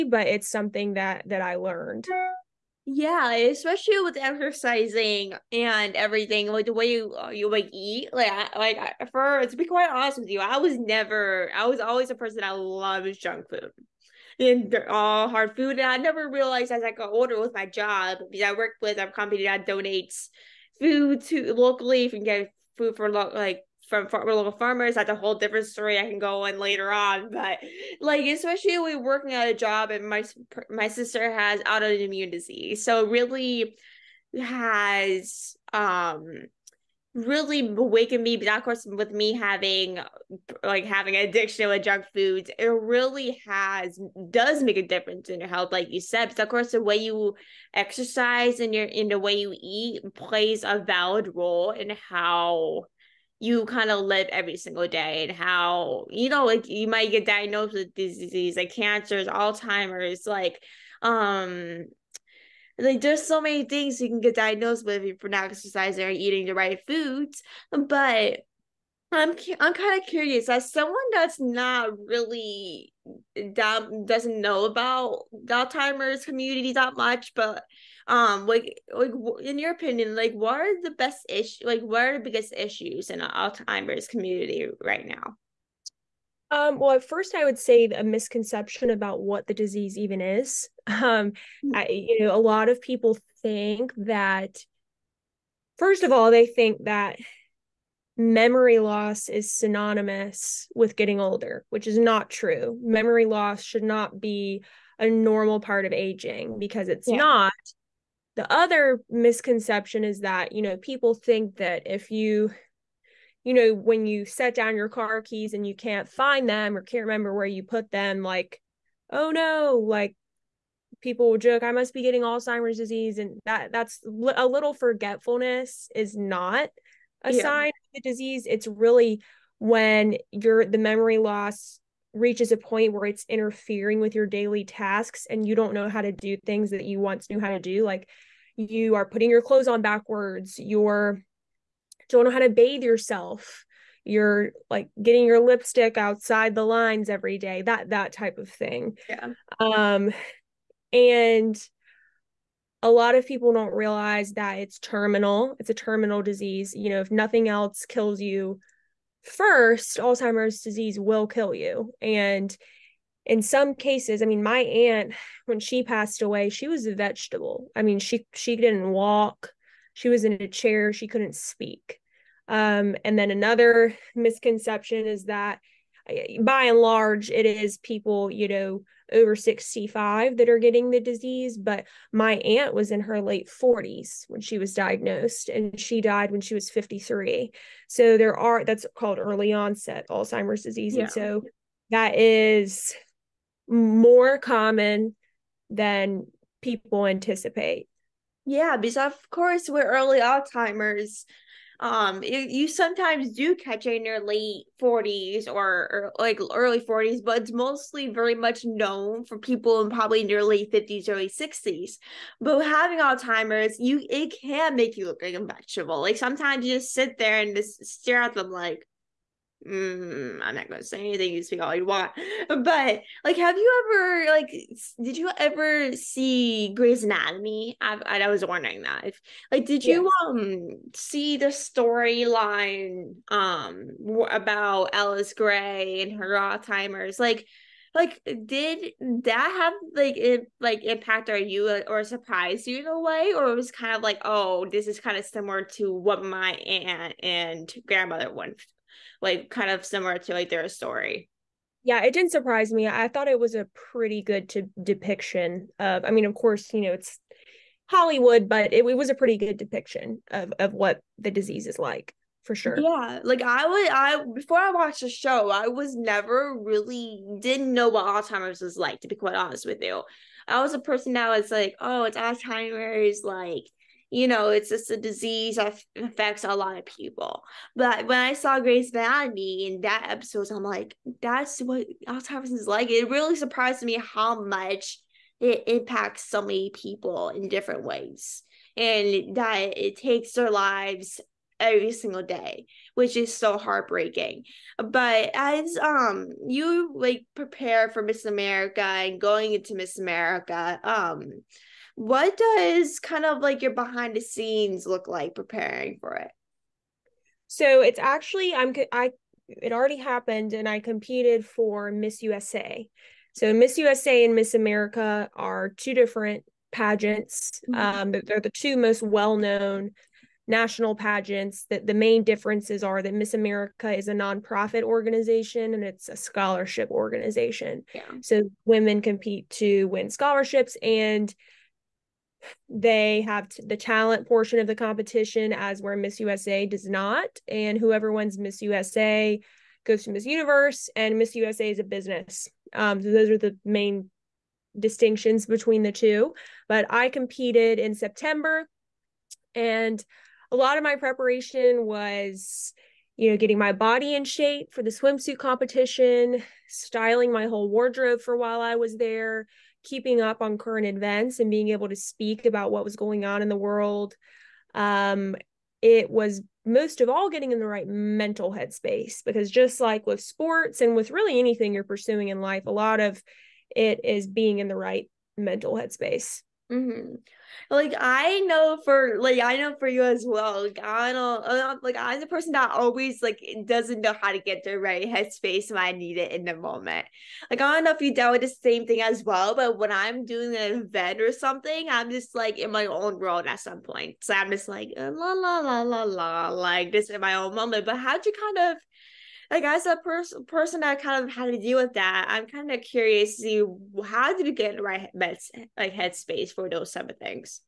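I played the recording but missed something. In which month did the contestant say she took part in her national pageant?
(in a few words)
September.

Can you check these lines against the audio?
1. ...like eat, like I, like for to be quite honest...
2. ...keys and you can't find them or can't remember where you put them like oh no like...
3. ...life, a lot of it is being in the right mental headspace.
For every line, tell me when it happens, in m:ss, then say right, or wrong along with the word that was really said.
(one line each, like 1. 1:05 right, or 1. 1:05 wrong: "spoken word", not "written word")
1. 0:07 right
2. 1:55 right
3. 6:12 right.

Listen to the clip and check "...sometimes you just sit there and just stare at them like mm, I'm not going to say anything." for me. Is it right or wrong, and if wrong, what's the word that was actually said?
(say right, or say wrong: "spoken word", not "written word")
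right.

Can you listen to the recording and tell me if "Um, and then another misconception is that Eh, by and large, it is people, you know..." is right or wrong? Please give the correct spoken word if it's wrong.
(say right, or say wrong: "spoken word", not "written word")
right.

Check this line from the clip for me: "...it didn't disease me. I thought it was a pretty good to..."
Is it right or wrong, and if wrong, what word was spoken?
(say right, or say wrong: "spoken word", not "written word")
wrong: "surprise", not "disease".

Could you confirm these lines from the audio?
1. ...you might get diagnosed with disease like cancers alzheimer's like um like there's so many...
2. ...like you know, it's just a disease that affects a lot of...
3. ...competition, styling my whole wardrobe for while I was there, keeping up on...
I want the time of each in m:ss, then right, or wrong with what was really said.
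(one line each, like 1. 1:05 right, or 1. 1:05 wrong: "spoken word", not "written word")
1. 0:56 right
2. 4:33 right
3. 5:55 right.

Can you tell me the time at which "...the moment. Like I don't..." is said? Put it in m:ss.
6:26.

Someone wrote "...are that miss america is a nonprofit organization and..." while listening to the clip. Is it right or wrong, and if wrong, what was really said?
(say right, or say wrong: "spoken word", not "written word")
right.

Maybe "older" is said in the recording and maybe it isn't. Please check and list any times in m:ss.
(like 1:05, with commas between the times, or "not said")
0:17, 1:41.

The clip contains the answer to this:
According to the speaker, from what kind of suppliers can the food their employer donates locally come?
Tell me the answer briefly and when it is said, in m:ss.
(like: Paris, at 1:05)
local farmers, at 0:24.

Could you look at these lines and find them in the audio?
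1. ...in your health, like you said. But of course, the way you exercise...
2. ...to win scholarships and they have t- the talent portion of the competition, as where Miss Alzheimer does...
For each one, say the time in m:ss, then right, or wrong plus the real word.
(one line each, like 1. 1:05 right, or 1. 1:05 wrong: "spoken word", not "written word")
1. 0:45 right
2. 5:29 wrong: "USA", not "Alzheimer".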